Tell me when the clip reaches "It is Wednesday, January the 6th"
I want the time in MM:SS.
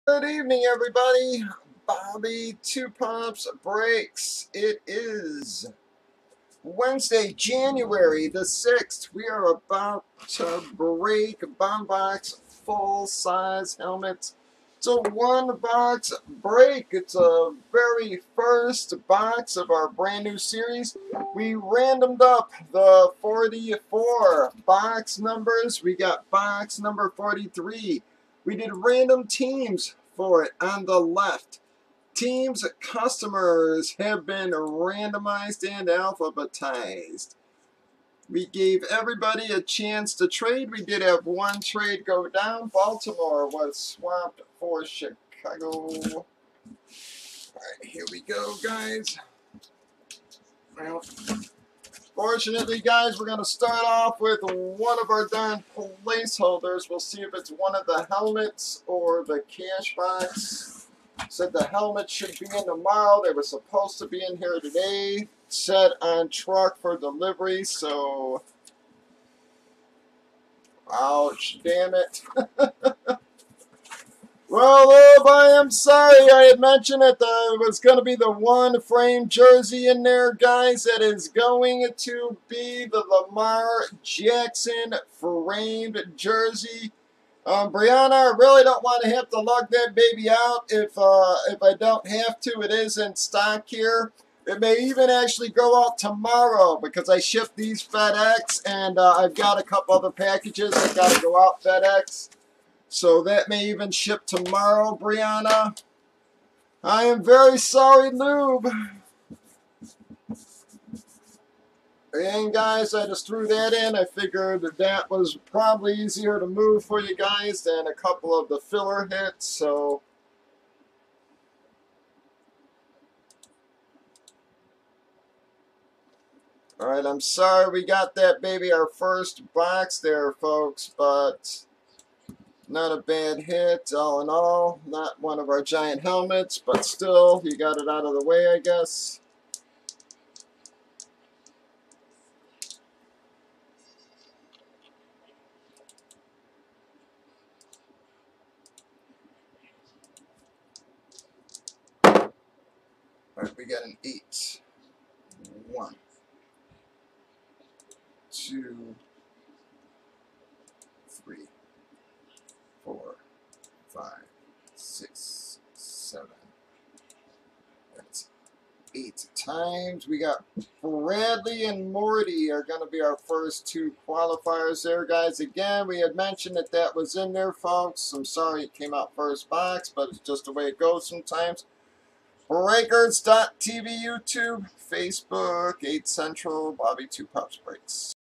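00:04.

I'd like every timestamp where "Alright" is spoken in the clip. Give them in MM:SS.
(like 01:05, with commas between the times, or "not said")
02:06, 02:33.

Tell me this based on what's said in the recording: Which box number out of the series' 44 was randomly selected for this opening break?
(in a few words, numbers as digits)
43.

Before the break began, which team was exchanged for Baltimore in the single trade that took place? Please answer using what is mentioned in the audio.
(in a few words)
Chicago.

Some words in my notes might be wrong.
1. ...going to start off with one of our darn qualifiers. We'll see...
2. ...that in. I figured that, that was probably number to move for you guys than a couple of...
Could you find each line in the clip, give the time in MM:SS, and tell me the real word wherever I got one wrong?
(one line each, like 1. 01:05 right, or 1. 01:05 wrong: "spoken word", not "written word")
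1. 00:53 wrong: "placeholders", not "qualifiers"
2. 01:53 wrong: "easier", not "number".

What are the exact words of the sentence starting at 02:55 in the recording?
Again, we had mentioned that that was in there, folks.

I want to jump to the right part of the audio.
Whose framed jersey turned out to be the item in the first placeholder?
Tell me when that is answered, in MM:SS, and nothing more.
01:23.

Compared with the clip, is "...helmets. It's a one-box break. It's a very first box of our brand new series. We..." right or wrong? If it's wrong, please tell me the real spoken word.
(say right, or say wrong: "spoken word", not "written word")
right.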